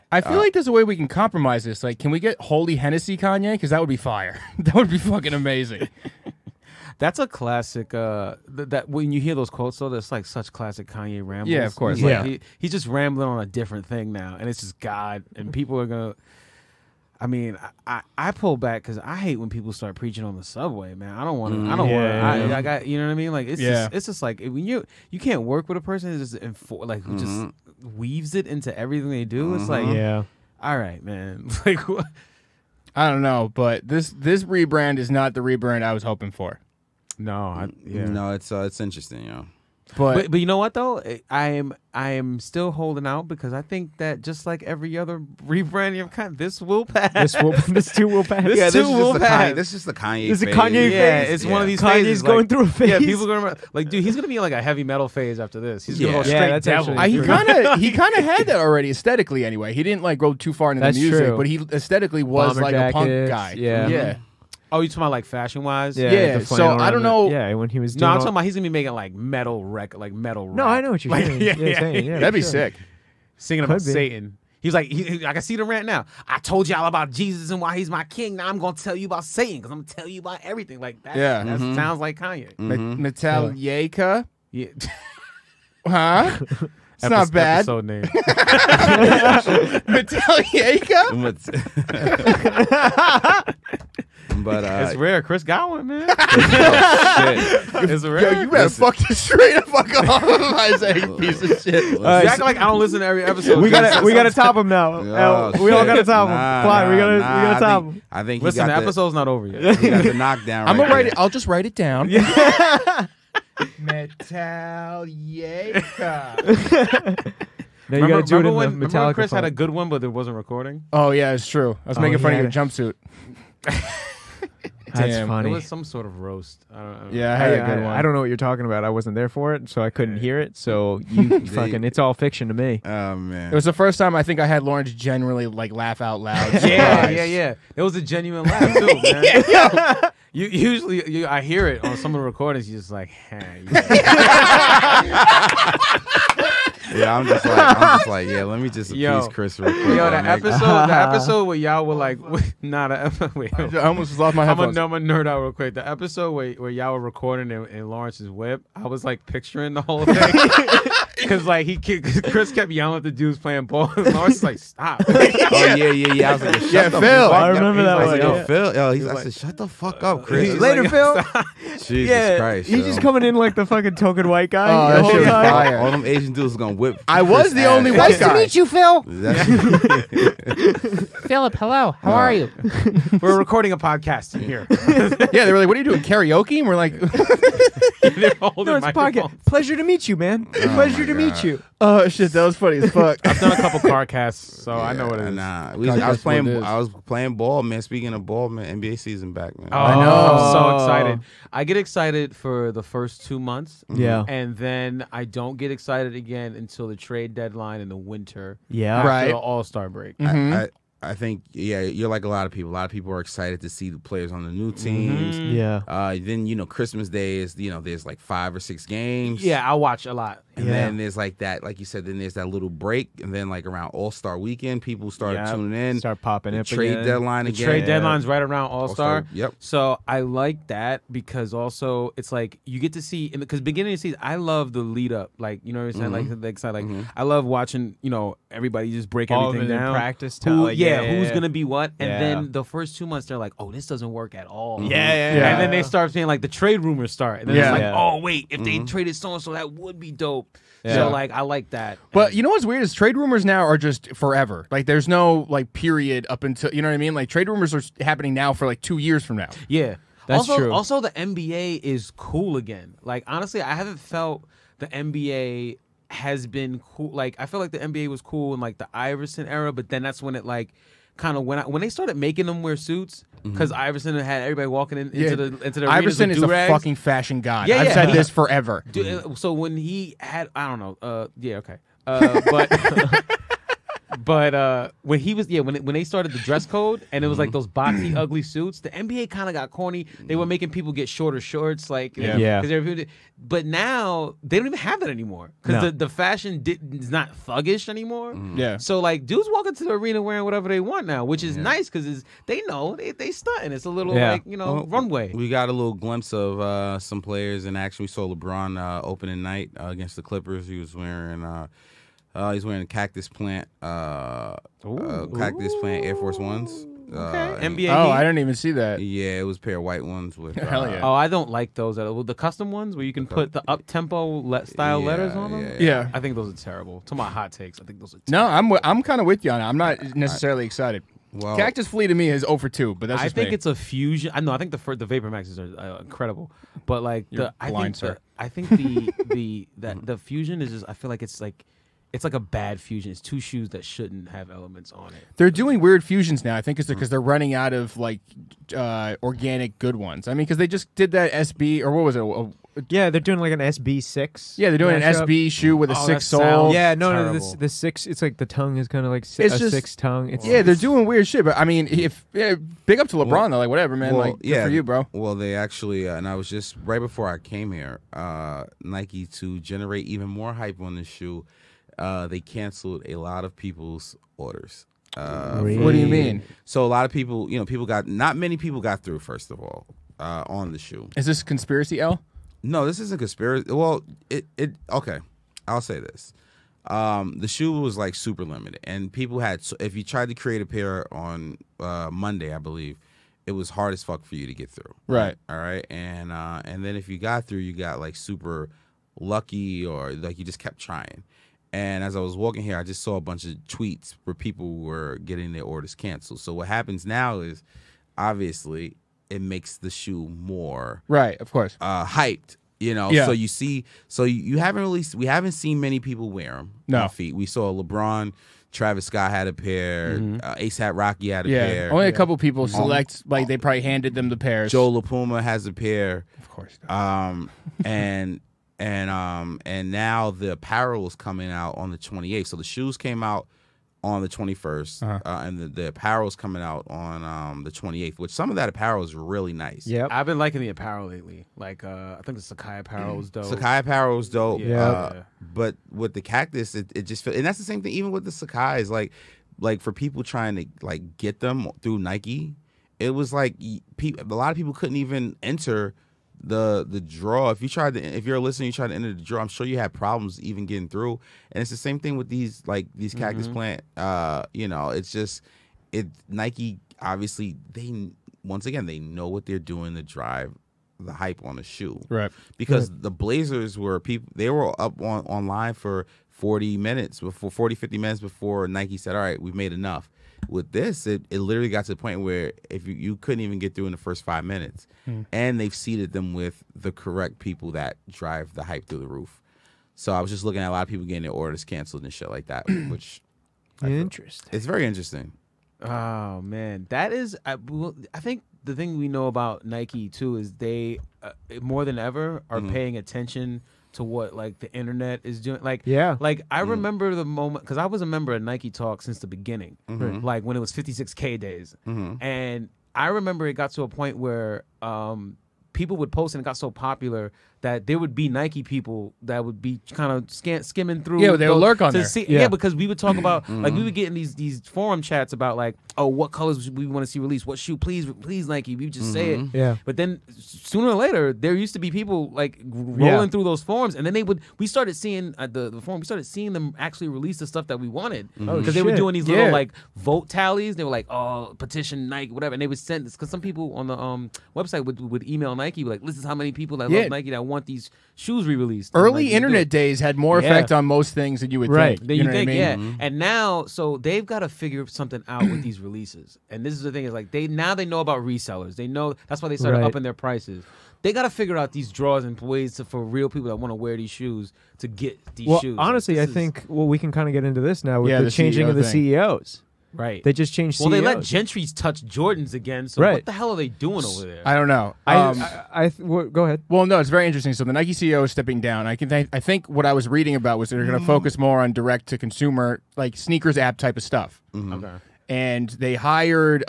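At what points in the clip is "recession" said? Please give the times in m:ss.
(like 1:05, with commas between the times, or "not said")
not said.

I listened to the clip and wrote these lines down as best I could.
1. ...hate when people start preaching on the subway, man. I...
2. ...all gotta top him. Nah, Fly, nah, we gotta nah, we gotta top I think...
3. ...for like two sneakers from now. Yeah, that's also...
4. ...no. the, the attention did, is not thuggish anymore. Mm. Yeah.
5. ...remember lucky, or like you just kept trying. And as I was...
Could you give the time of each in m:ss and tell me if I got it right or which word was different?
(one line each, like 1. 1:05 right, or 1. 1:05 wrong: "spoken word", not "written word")
1. 0:19 right
2. 1:45 right
3. 4:18 wrong: "years", not "sneakers"
4. 4:55 wrong: "fashion", not "attention"
5. 6:38 wrong: "super", not "remember".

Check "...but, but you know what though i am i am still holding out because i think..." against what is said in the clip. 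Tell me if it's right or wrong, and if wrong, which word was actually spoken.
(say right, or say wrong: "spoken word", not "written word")
right.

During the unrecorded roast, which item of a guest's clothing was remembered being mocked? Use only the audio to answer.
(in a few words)
jumpsuit.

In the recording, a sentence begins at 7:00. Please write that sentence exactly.
uh, ASAP Rocky had a yeah.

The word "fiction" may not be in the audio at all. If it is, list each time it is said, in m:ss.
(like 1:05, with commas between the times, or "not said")
2:12.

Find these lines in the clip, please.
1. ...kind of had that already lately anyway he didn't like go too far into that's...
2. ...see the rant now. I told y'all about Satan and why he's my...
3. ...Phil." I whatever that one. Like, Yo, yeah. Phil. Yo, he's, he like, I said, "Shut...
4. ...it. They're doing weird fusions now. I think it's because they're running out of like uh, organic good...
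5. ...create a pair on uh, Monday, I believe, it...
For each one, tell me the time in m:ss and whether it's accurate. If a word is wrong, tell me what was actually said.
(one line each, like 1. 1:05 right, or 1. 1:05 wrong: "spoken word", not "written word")
1. 0:57 wrong: "aesthetically", not "lately"
2. 1:15 wrong: "Jesus", not "Satan"
3. 2:46 wrong: "remember", not "whatever"
4. 5:45 right
5. 6:30 right.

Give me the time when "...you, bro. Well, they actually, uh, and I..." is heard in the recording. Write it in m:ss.
6:04.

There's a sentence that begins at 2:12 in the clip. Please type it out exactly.
Oh man, It was the first time I think I had Lawrence generally like laugh out loud.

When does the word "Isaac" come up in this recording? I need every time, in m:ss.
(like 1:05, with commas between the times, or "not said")
1:40.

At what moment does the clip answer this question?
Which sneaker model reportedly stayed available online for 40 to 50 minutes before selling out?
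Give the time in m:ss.
7:53.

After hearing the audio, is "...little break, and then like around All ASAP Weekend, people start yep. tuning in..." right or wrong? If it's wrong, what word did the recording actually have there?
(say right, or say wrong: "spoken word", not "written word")
wrong: "Star", not "ASAP".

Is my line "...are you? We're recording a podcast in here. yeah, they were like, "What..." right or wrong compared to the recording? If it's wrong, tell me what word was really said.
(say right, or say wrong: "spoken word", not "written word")
right.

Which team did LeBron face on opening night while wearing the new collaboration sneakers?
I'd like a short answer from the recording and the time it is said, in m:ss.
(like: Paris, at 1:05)
Clippers, at 5:10.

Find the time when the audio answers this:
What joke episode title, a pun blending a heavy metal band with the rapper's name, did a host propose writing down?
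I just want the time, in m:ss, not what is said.
1:53.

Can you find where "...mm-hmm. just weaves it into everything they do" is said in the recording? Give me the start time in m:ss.
0:27.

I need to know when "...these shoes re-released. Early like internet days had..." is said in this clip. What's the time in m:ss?
9:07.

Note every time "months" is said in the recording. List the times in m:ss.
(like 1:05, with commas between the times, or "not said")
3:23, 4:03.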